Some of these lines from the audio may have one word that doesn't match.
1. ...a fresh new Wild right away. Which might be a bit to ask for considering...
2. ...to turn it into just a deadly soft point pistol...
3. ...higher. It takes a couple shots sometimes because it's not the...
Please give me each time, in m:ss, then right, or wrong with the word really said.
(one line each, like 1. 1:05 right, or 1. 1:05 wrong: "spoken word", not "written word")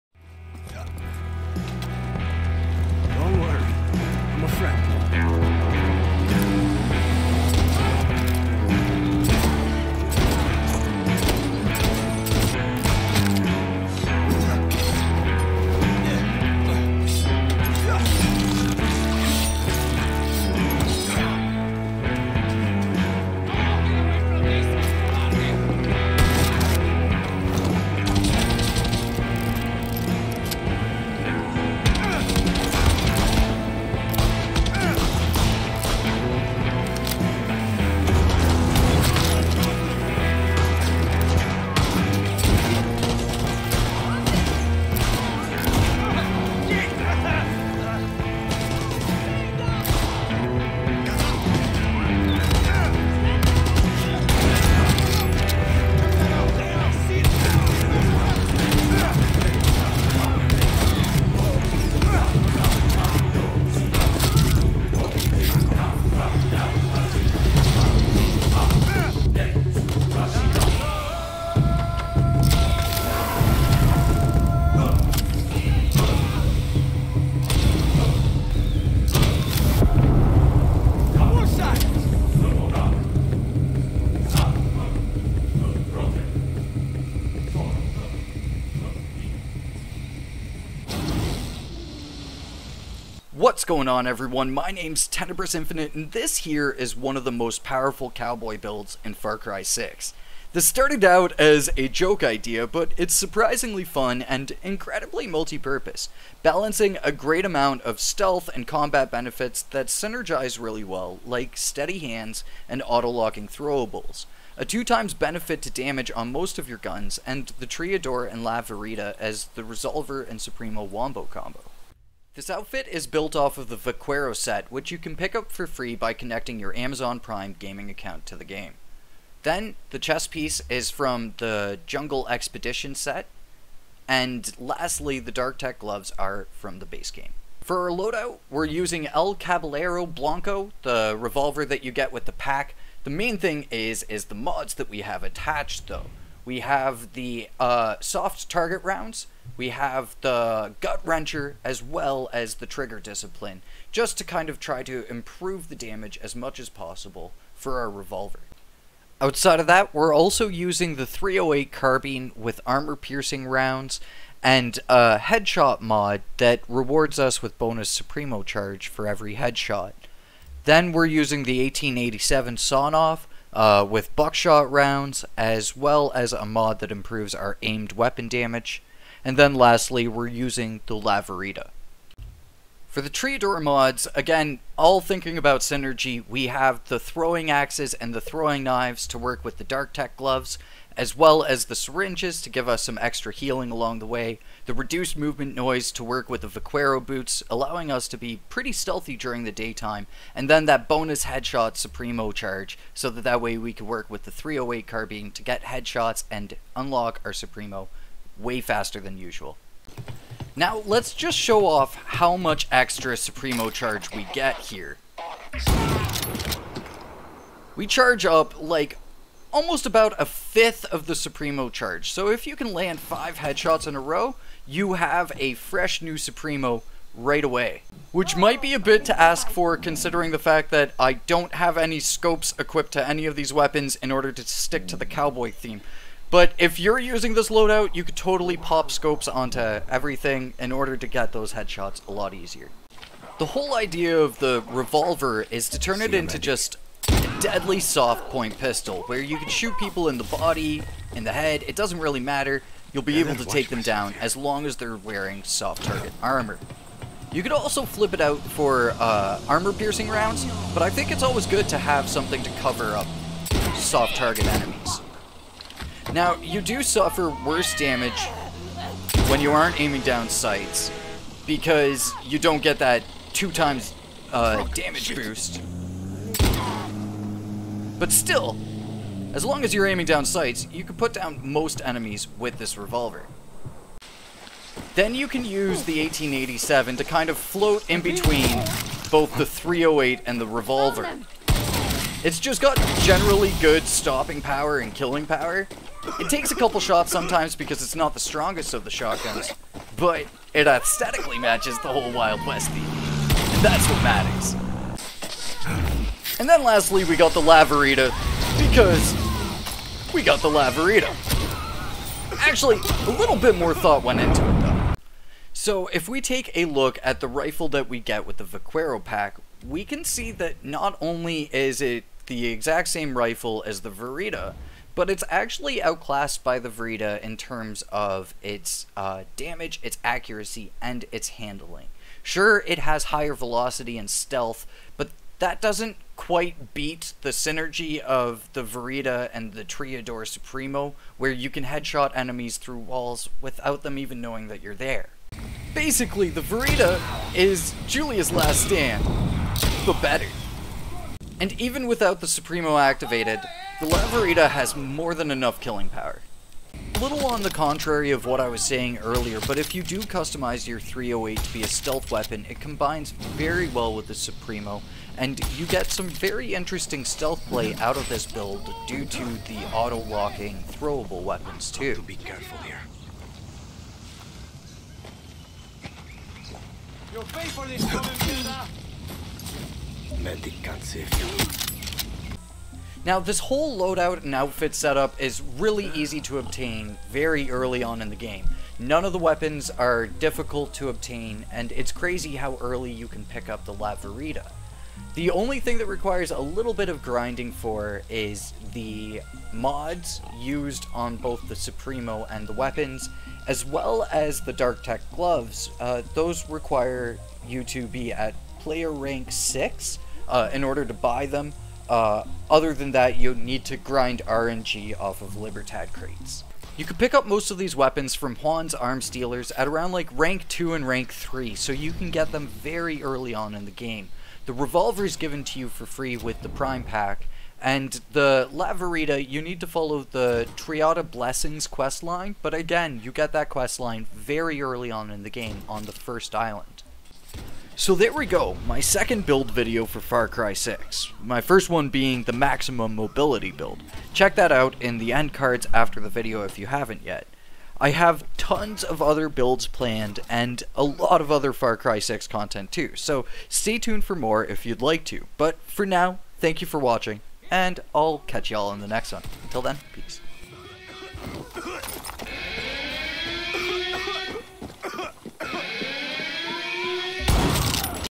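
1. 3:45 wrong: "Supremo", not "Wild"
2. 4:05 right
3. 4:55 wrong: "power", not "higher".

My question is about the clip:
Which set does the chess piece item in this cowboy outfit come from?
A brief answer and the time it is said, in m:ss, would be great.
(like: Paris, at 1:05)
Jungle Expedition, at 2:11.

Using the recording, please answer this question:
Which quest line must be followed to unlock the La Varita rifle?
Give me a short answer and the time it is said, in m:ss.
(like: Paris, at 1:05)
Triada Blessings, at 7:10.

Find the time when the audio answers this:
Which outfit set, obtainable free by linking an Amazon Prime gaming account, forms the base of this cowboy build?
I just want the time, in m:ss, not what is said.
2:03.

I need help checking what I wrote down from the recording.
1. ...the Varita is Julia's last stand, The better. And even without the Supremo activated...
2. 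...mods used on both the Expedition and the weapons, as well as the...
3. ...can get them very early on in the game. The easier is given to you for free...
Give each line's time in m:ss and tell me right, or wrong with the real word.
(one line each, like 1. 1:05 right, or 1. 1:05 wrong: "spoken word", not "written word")
1. 5:46 right
2. 6:39 wrong: "Supremo", not "Expedition"
3. 7:01 wrong: "revolver", not "easier".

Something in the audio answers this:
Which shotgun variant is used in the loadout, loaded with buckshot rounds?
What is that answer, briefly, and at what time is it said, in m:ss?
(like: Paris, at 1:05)
1887 sawn off, at 2:51.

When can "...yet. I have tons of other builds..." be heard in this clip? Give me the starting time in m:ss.
7:27.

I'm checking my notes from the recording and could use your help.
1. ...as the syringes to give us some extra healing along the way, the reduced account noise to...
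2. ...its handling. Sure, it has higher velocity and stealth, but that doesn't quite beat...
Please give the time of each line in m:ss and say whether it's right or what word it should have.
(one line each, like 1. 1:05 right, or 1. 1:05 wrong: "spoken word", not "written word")
1. 3:11 wrong: "movement", not "account"
2. 5:31 right.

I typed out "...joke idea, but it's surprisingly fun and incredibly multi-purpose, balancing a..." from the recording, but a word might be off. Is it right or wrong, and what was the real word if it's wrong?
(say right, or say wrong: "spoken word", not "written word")
right.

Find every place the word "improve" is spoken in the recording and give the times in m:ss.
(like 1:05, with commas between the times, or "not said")
2:35, 2:56.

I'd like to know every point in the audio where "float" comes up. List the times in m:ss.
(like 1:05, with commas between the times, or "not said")
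4:47.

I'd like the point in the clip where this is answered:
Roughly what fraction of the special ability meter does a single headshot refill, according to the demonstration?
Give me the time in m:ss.
3:40.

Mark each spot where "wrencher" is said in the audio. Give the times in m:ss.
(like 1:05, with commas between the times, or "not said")
2:31.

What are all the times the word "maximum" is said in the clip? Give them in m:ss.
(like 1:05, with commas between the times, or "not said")
7:22.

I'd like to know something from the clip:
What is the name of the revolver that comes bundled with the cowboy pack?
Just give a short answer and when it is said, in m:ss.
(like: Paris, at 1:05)
El Caballero Blanco, at 2:19.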